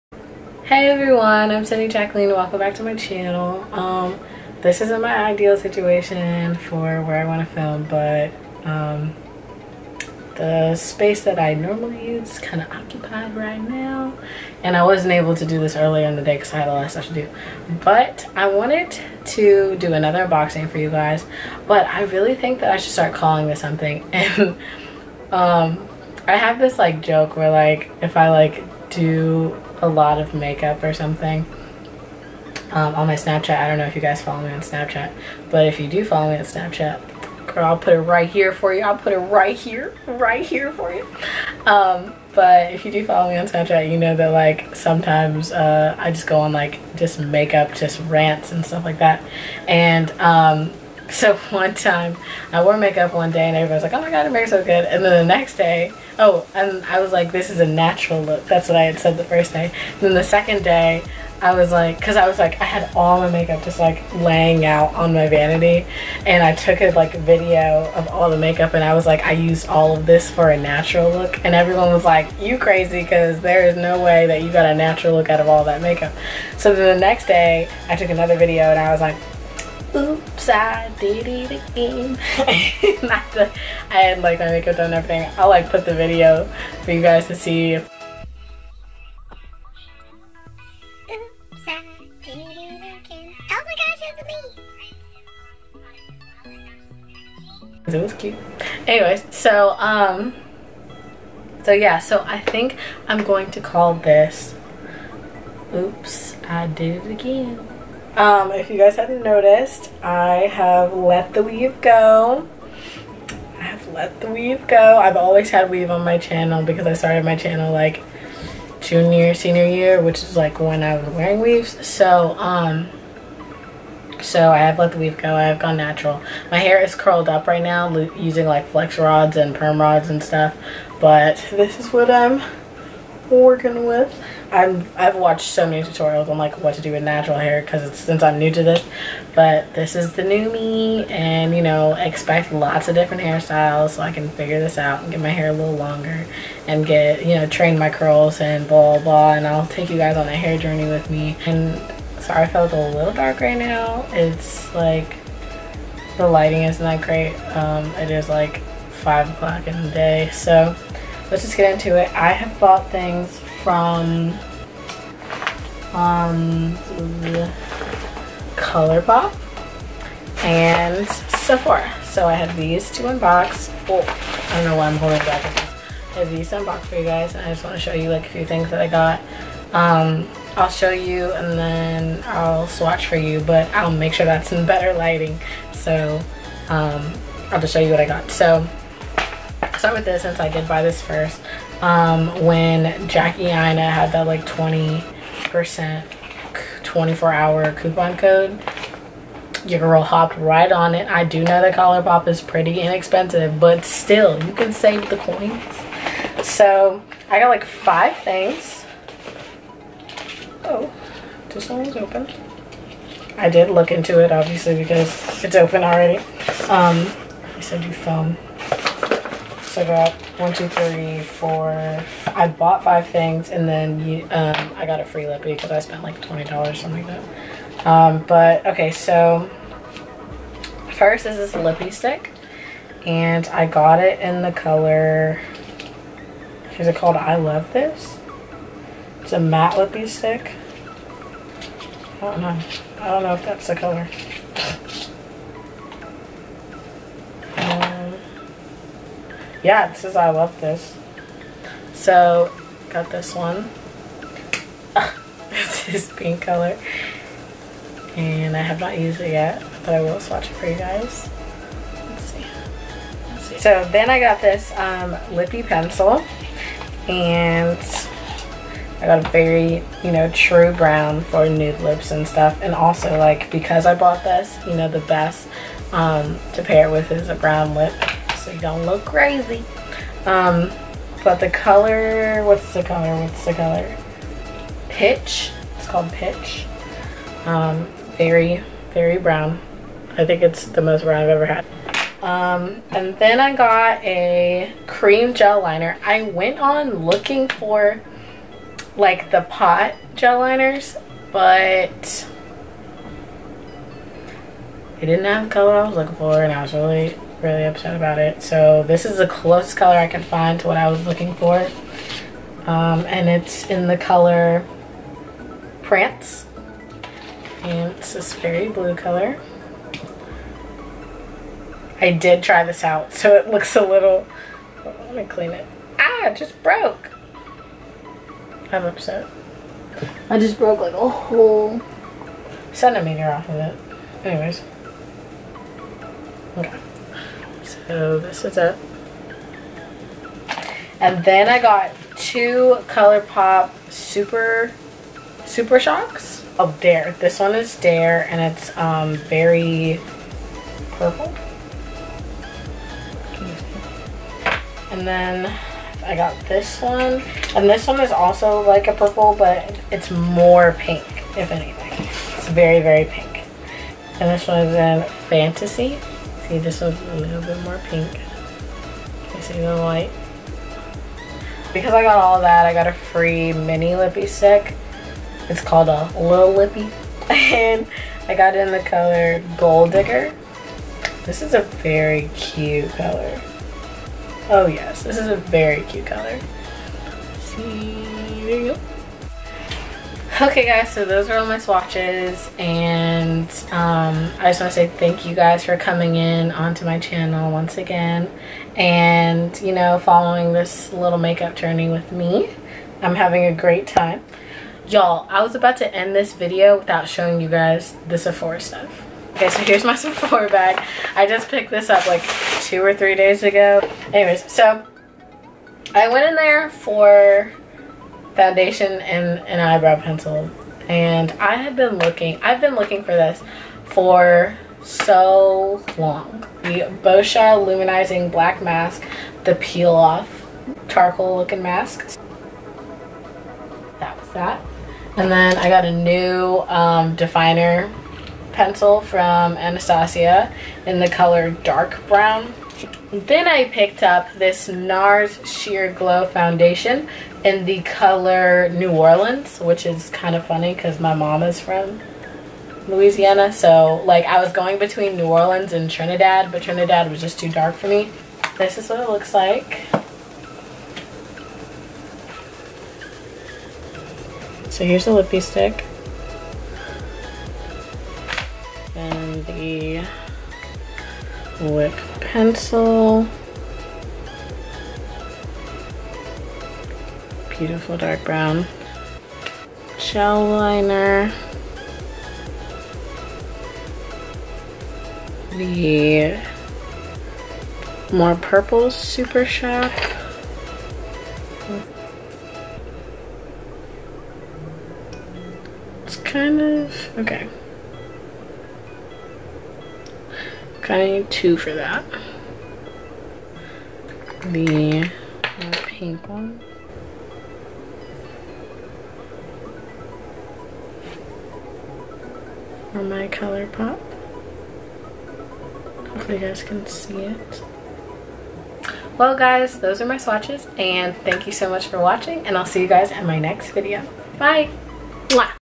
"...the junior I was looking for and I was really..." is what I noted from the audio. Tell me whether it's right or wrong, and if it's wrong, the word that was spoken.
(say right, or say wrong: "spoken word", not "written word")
wrong: "color", not "junior".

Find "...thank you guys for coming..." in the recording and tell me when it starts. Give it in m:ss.
6:34.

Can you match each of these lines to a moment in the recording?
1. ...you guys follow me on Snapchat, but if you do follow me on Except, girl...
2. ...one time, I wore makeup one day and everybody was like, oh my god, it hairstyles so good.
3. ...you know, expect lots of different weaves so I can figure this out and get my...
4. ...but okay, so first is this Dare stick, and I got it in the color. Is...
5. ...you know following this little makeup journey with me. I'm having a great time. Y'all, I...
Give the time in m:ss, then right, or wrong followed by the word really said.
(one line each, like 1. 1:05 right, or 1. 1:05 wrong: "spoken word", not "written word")
1. 0:33 wrong: "Snapchat", not "Except"
2. 0:51 wrong: "makes", not "hairstyles"
3. 2:21 wrong: "hairstyles", not "weaves"
4. 3:48 wrong: "Lippie", not "Dare"
5. 6:39 right.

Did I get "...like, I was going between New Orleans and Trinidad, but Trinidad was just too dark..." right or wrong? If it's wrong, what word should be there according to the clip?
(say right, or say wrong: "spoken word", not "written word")
right.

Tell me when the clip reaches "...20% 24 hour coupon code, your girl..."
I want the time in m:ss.
3:14.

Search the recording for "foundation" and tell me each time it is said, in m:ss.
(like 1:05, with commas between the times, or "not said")
6:58, 7:26.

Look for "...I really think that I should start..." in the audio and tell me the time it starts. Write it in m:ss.
0:21.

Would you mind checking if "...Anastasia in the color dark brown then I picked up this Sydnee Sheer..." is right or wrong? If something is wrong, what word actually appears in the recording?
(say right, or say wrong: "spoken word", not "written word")
wrong: "NARS", not "Sydnee".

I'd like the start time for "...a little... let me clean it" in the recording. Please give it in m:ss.
5:23.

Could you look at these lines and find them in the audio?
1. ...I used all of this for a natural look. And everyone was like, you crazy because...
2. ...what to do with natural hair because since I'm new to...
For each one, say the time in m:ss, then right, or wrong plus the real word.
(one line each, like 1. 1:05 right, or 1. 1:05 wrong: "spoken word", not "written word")
1. 1:09 right
2. 2:16 right.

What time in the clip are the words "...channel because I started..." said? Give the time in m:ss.
1:56.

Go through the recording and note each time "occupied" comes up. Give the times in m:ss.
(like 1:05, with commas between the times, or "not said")
0:12.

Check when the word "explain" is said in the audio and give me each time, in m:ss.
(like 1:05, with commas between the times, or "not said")
not said.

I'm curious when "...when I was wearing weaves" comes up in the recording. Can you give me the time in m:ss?
2:00.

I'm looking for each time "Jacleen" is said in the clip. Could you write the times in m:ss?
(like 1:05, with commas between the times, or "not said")
0:01.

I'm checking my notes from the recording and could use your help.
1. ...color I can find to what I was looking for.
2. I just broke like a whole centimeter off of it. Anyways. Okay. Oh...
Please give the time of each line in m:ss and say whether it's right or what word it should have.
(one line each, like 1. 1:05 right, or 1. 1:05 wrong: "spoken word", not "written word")
1. 5:09 right
2. 5:30 right.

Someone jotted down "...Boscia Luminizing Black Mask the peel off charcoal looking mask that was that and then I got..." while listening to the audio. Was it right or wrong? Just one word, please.
right.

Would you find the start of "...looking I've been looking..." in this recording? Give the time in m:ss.
7:01.